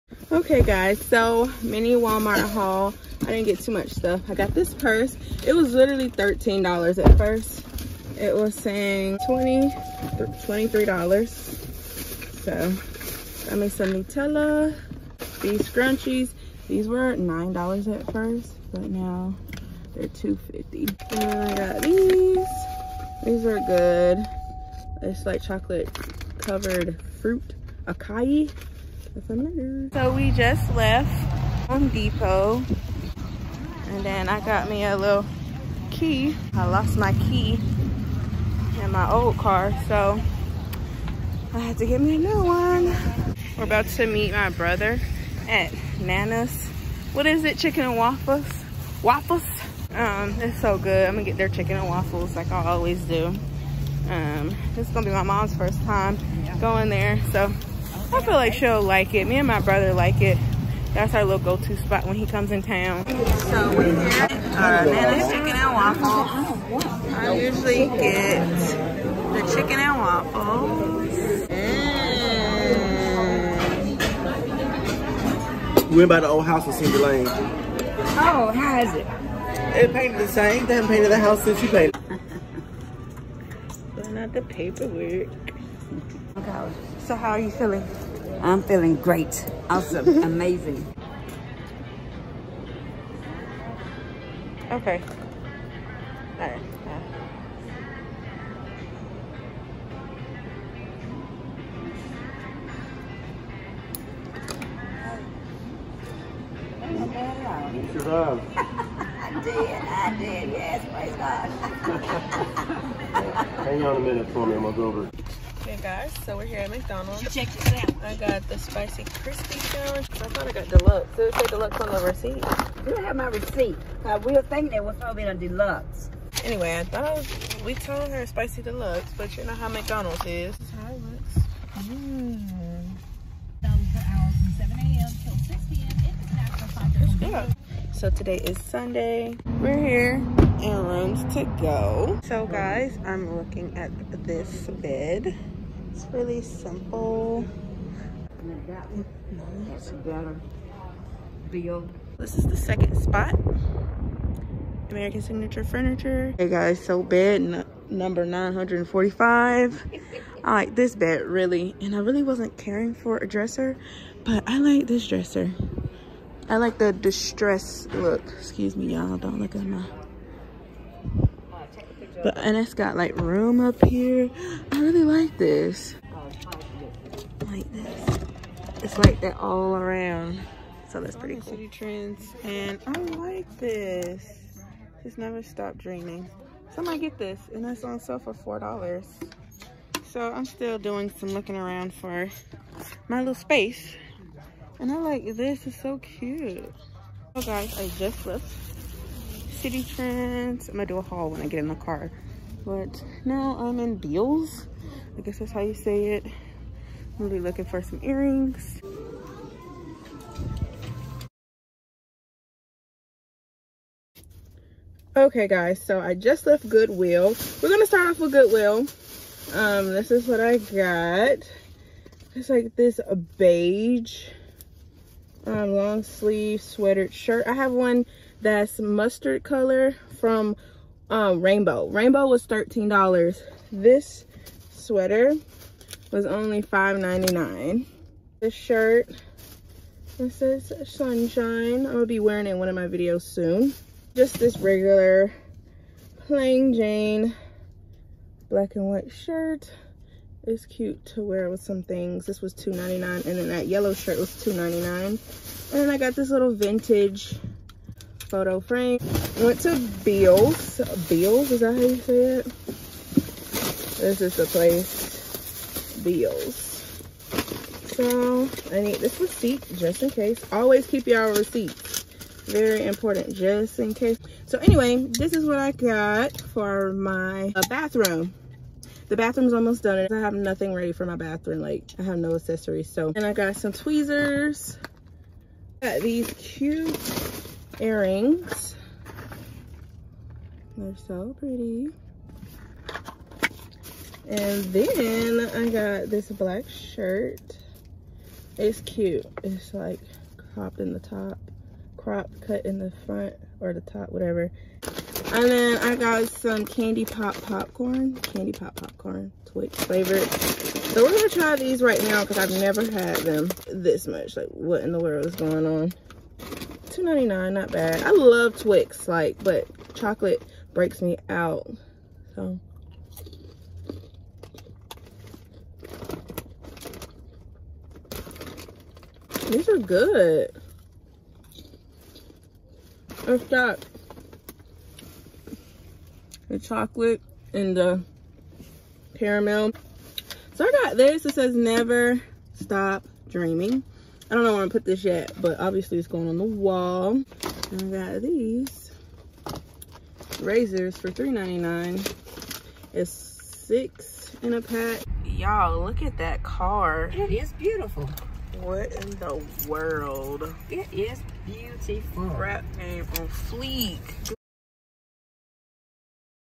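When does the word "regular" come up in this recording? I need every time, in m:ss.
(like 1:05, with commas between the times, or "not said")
4:04.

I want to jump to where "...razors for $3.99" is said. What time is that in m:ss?
5:50.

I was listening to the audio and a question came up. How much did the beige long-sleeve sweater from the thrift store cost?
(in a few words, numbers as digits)
$5.99.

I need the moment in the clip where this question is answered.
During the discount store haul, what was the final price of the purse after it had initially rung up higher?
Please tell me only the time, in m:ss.
0:06.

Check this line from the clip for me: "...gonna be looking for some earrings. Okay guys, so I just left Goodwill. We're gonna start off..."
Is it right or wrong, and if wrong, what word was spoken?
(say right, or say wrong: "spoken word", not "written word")
right.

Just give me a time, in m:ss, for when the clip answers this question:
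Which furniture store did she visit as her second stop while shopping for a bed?
2:34.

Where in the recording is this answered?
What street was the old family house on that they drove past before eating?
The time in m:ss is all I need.
1:16.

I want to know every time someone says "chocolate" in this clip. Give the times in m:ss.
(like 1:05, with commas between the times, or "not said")
0:25, 5:19, 5:36.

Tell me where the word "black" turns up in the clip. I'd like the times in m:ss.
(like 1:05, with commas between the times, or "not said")
4:08, 4:56.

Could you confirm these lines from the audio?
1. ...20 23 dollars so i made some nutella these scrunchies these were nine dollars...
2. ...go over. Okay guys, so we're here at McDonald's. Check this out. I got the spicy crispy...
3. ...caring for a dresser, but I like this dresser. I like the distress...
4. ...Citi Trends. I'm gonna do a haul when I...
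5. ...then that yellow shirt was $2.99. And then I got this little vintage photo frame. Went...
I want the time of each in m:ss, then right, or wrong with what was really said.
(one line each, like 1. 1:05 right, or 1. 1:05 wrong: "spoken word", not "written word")
1. 0:09 right
2. 1:54 right
3. 2:42 right
4. 3:19 right
5. 4:13 right.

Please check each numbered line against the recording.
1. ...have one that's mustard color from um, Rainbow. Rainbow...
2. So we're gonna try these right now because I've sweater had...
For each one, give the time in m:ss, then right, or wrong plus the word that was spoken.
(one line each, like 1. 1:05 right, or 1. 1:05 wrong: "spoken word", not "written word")
1. 3:47 right
2. 5:10 wrong: "never", not "sweater".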